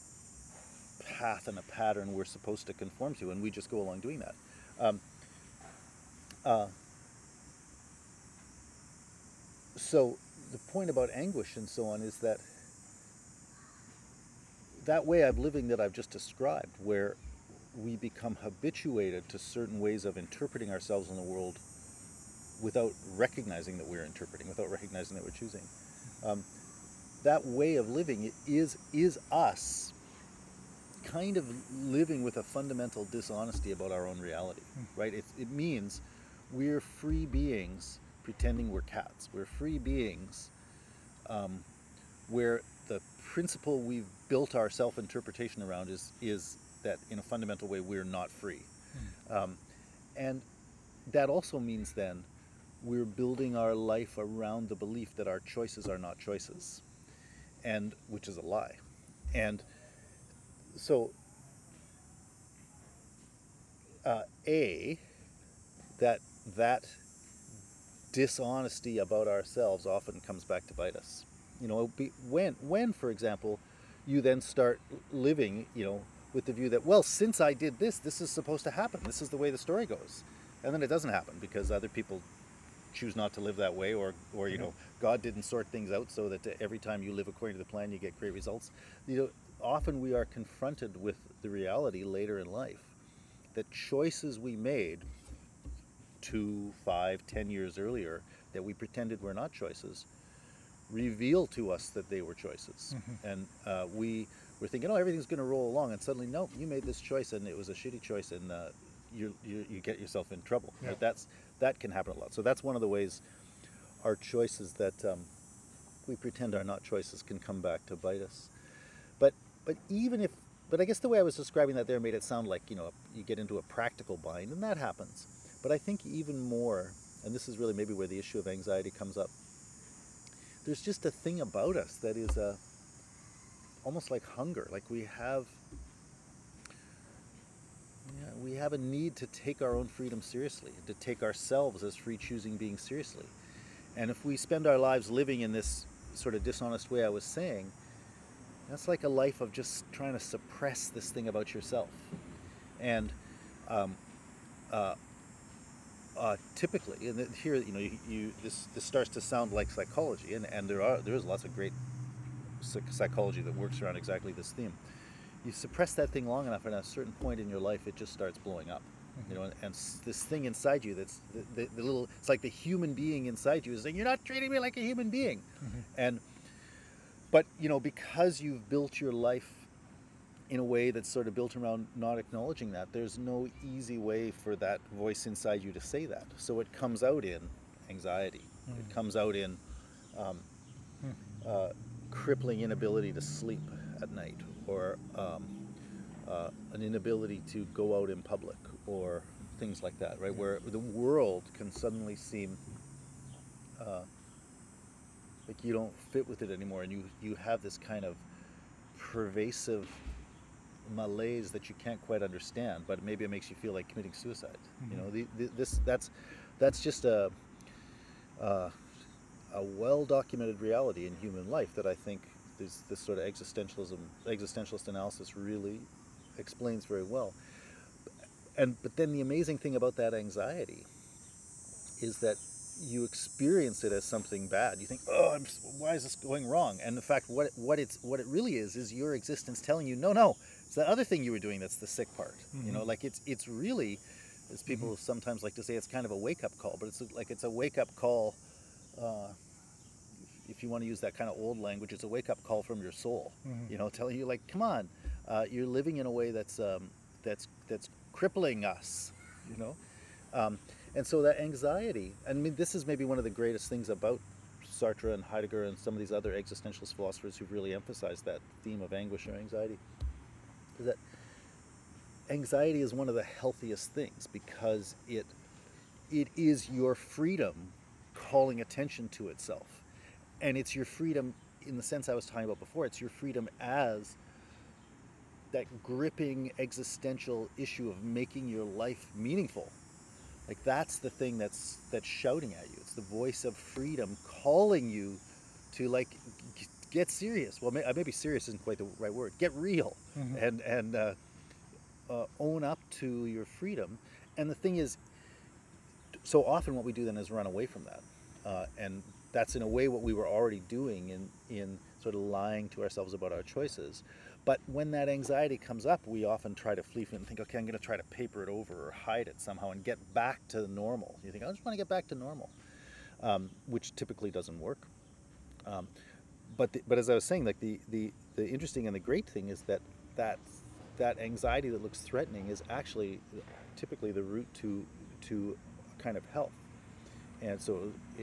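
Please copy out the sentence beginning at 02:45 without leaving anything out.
You suppress that thing long enough, and at a certain point in your life, it just starts blowing up.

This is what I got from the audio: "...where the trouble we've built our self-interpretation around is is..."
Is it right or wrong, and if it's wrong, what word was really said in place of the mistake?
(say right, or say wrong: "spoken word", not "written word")
wrong: "principle", not "trouble".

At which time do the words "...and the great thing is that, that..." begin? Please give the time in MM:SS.
05:28.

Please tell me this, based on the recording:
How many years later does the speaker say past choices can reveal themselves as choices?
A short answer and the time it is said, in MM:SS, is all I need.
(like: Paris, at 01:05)
2, 5, 10, at 01:36.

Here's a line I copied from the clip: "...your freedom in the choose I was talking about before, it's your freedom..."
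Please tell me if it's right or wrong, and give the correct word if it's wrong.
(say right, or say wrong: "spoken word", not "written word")
wrong: "sense", not "choose".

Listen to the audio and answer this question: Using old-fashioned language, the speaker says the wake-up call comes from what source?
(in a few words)
your soul.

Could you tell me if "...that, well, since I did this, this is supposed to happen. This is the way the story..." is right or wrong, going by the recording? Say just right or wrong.
right.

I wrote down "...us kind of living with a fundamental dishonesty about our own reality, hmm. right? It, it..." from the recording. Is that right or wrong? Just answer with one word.
right.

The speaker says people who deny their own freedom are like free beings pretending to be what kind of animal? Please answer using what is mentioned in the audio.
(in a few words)
cats.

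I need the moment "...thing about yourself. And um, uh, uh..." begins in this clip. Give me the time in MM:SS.
02:31.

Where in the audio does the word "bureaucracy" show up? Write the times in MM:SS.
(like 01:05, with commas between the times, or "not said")
not said.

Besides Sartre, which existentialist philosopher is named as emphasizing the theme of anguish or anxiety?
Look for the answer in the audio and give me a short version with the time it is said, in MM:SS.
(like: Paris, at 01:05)
Heidegger, at 04:25.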